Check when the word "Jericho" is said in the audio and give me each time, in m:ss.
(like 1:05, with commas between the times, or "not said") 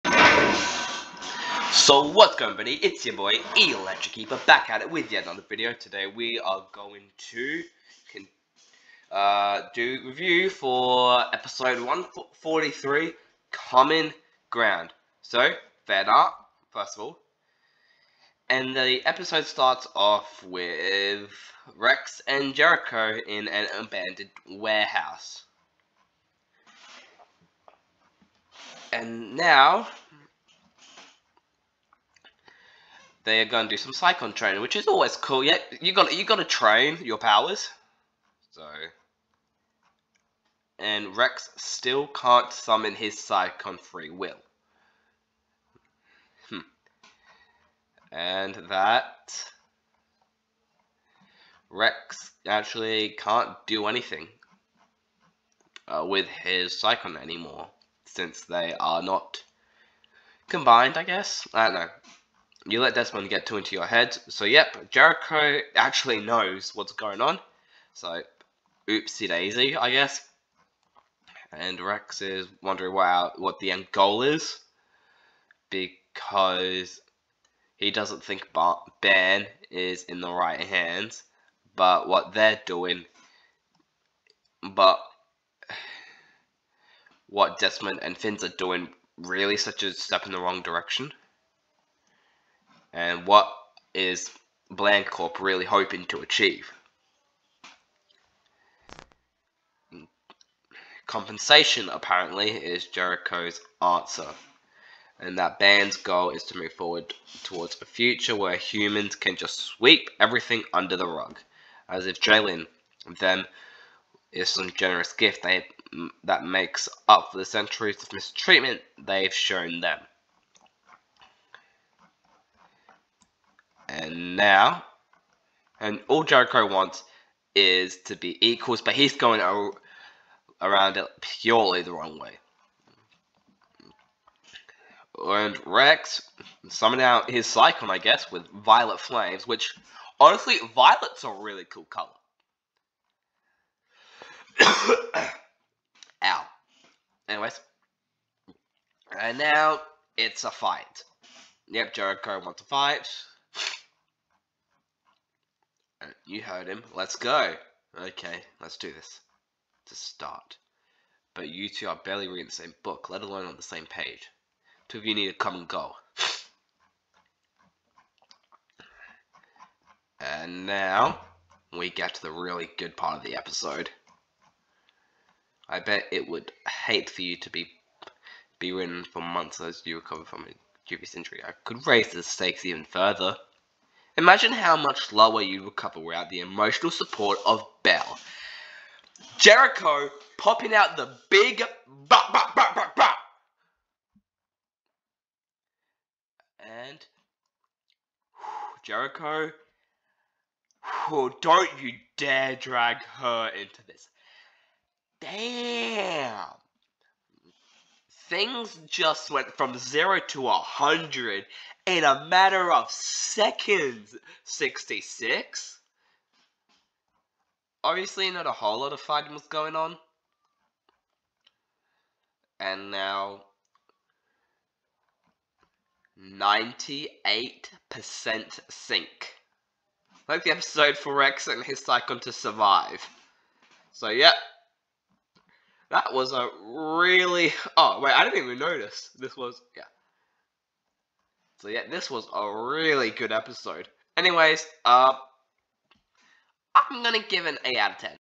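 0:22, 1:04, 1:42, 2:06, 2:31, 3:09, 3:18.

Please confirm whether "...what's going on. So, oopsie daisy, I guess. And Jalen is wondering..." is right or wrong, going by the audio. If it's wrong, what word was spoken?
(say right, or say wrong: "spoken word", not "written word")
wrong: "Rex", not "Jalen".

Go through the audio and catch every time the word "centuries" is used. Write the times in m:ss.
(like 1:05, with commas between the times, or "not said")
1:57.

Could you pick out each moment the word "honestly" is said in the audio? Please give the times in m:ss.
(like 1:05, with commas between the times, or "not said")
2:20.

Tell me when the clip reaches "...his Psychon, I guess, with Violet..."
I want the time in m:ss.
2:17.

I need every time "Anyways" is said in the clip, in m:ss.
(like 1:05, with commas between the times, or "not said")
2:27, 4:04.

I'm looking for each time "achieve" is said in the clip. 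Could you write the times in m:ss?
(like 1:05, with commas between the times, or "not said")
1:36.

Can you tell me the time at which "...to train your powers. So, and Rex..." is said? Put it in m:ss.
0:36.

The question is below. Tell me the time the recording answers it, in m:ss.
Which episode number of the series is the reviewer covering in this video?
0:11.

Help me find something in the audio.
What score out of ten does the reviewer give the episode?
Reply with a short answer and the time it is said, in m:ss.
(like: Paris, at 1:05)
8, at 4:07.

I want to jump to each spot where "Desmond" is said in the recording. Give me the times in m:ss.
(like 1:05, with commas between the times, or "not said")
1:02, 1:27.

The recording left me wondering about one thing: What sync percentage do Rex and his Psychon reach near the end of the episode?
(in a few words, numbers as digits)
98%.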